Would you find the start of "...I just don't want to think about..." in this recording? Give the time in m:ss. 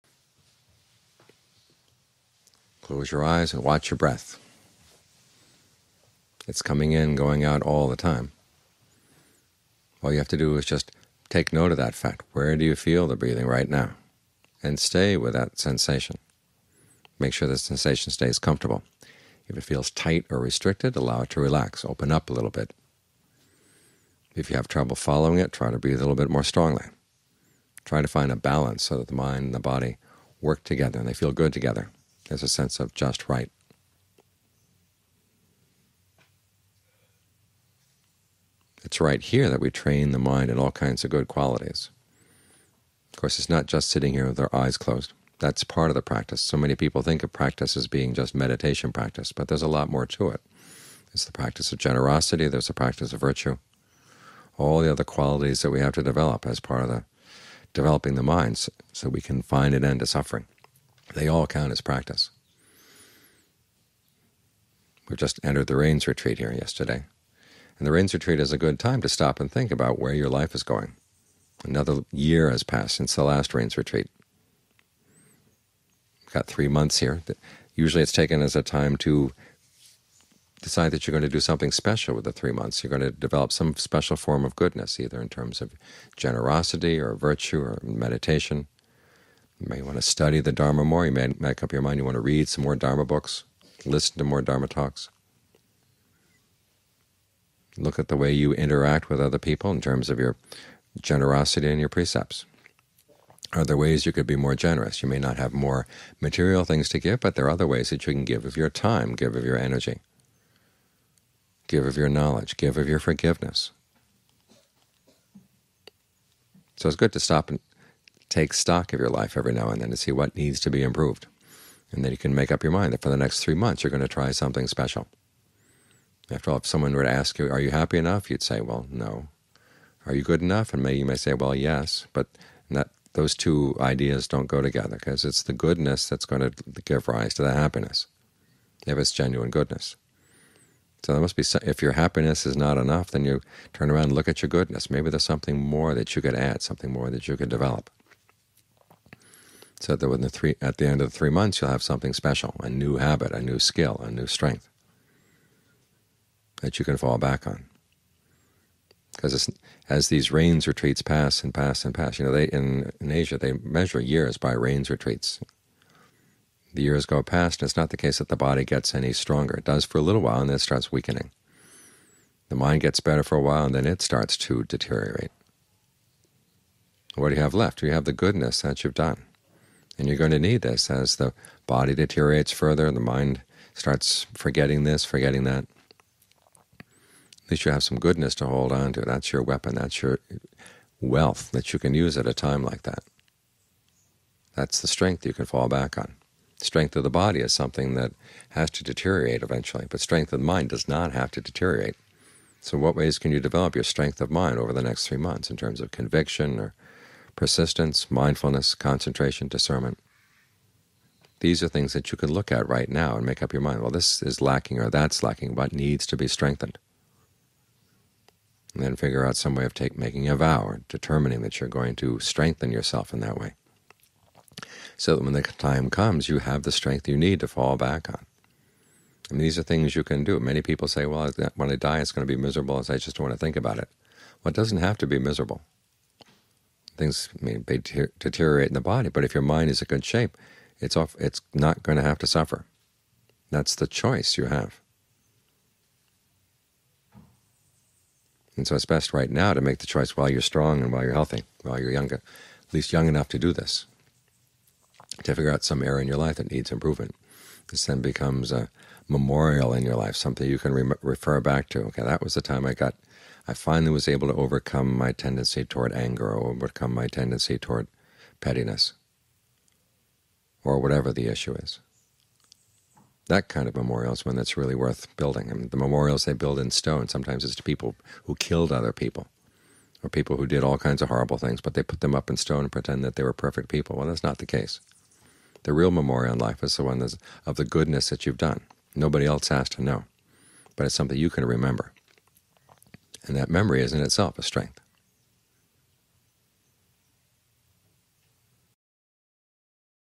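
3:52.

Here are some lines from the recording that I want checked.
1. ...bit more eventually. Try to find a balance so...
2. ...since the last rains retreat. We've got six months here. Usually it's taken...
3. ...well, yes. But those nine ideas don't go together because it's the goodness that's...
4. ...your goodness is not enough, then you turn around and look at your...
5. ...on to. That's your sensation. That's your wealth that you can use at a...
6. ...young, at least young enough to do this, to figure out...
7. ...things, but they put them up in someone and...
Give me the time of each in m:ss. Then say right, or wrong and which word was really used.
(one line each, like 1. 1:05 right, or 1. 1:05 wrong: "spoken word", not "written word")
1. 0:26 wrong: "strongly", not "eventually"
2. 1:12 wrong: "three", not "six"
3. 2:11 wrong: "two", not "nine"
4. 2:21 wrong: "happiness", not "goodness"
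5. 3:08 wrong: "weapon", not "sensation"
6. 4:11 right
7. 4:41 wrong: "stone", not "someone".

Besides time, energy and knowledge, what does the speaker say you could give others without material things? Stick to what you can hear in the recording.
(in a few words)
Forgiveness.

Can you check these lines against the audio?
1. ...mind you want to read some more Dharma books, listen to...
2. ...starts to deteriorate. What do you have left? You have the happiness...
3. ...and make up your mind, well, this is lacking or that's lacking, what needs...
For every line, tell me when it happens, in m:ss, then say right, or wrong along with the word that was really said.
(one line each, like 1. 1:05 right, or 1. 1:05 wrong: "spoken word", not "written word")
1. 1:31 right
2. 2:54 wrong: "goodness", not "happiness"
3. 3:33 right.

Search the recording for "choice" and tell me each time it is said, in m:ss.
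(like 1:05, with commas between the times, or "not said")
4:03, 4:09.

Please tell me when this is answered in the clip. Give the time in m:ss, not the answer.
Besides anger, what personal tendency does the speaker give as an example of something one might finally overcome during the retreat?
4:28.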